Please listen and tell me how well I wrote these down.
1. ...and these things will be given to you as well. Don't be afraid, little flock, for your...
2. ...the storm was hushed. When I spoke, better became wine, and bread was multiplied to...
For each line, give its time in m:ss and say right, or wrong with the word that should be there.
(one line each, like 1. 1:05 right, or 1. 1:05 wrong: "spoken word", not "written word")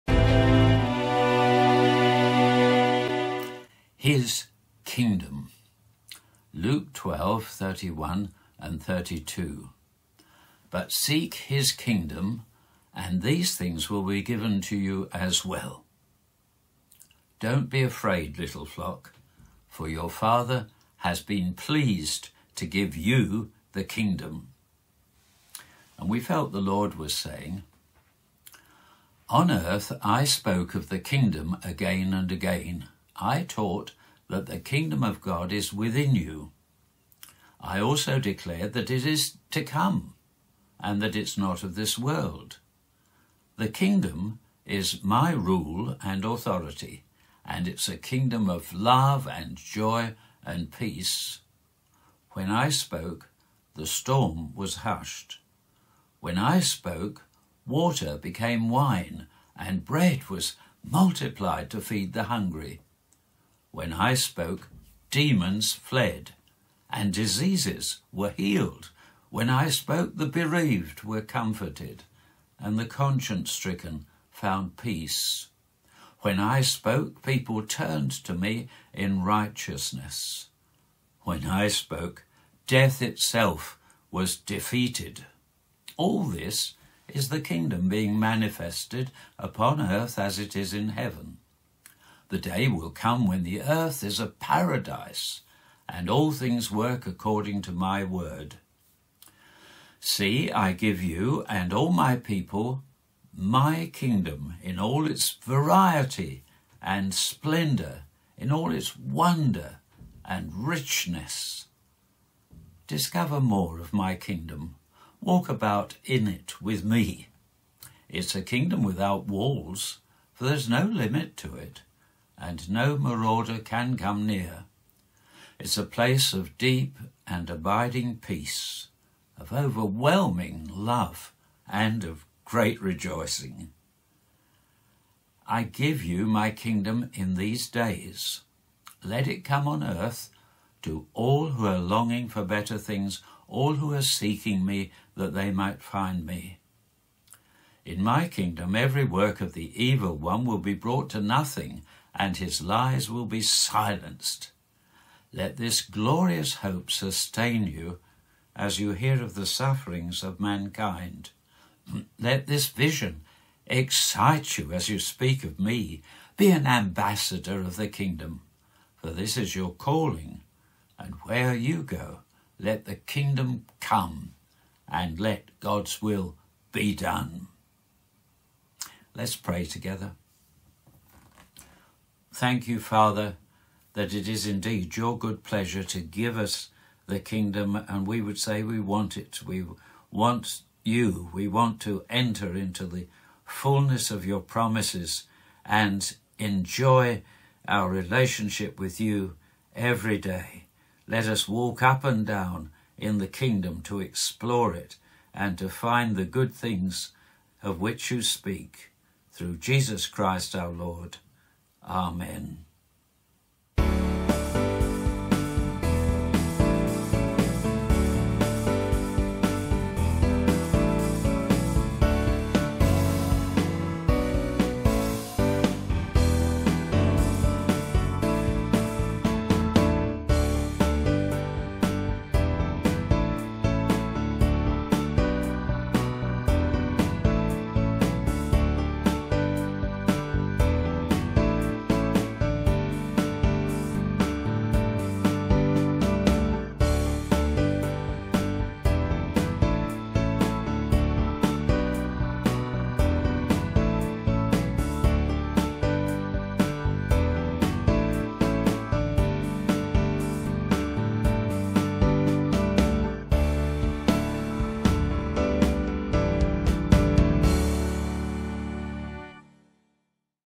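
1. 0:12 right
2. 0:53 wrong: "water", not "better".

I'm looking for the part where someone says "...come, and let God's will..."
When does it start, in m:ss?
2:53.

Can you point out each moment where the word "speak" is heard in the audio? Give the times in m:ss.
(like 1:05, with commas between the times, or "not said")
2:44, 3:28.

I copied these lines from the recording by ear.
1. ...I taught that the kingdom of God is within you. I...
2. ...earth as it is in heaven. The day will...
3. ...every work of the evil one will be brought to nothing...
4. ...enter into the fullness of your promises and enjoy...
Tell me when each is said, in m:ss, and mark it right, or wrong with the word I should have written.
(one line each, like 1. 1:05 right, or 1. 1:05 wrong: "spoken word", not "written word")
1. 0:33 right
2. 1:29 right
3. 2:28 right
4. 3:12 right.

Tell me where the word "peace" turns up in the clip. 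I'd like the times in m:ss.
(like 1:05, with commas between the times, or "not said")
0:50, 1:14, 2:08.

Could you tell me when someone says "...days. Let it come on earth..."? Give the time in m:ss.
2:17.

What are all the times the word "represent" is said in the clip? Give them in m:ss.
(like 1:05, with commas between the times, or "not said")
not said.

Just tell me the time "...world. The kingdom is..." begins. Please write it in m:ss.
0:41.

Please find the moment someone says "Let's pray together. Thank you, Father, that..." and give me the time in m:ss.
2:59.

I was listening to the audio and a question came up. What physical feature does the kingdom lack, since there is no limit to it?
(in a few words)
walls.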